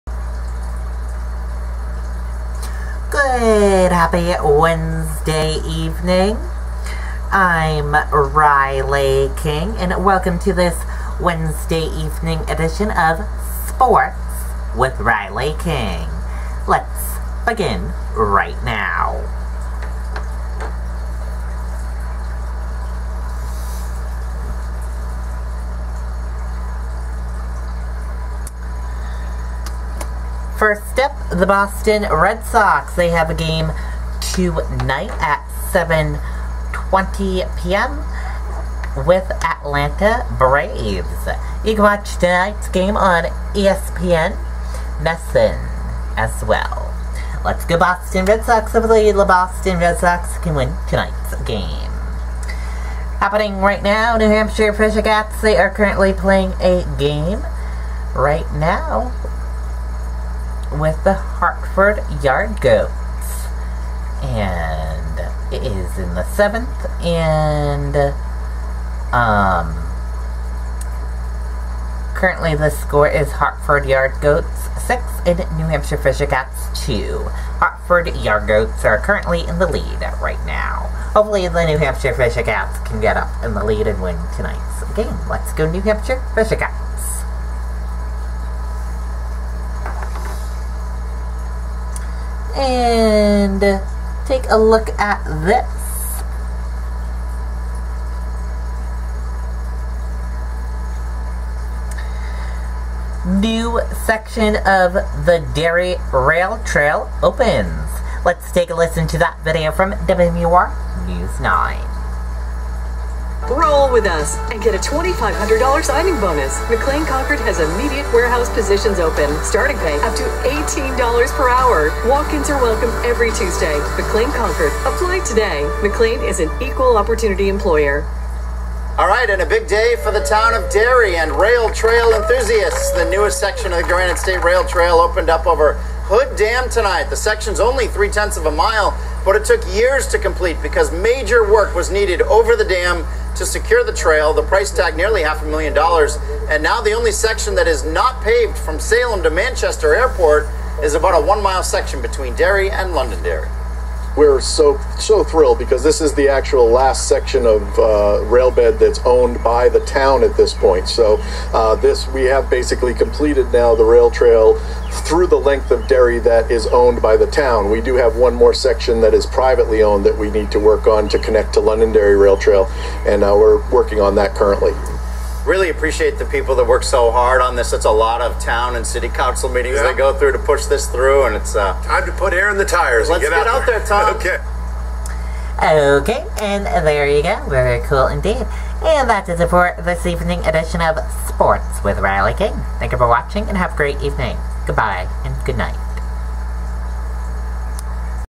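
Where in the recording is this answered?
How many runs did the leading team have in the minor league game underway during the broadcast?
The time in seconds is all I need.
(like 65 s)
74 s.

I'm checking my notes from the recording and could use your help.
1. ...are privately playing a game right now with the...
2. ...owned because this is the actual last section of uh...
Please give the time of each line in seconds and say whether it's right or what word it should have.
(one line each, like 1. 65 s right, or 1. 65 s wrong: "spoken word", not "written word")
1. 55 s wrong: "currently", not "privately"
2. 155 s wrong: "thrilled", not "owned".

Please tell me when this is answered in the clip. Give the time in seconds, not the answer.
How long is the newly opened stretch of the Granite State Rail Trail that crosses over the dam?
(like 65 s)
137 s.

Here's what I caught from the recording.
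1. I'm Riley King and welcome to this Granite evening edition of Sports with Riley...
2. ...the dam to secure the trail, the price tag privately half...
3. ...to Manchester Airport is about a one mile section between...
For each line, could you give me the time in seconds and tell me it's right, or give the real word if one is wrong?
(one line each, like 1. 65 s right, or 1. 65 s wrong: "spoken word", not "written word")
1. 7 s wrong: "Wednesday", not "Granite"
2. 142 s wrong: "nearly", not "privately"
3. 149 s right.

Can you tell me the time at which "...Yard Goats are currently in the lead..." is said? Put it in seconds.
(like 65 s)
78 s.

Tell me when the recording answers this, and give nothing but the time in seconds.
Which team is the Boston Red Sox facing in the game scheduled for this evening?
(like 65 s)
39 s.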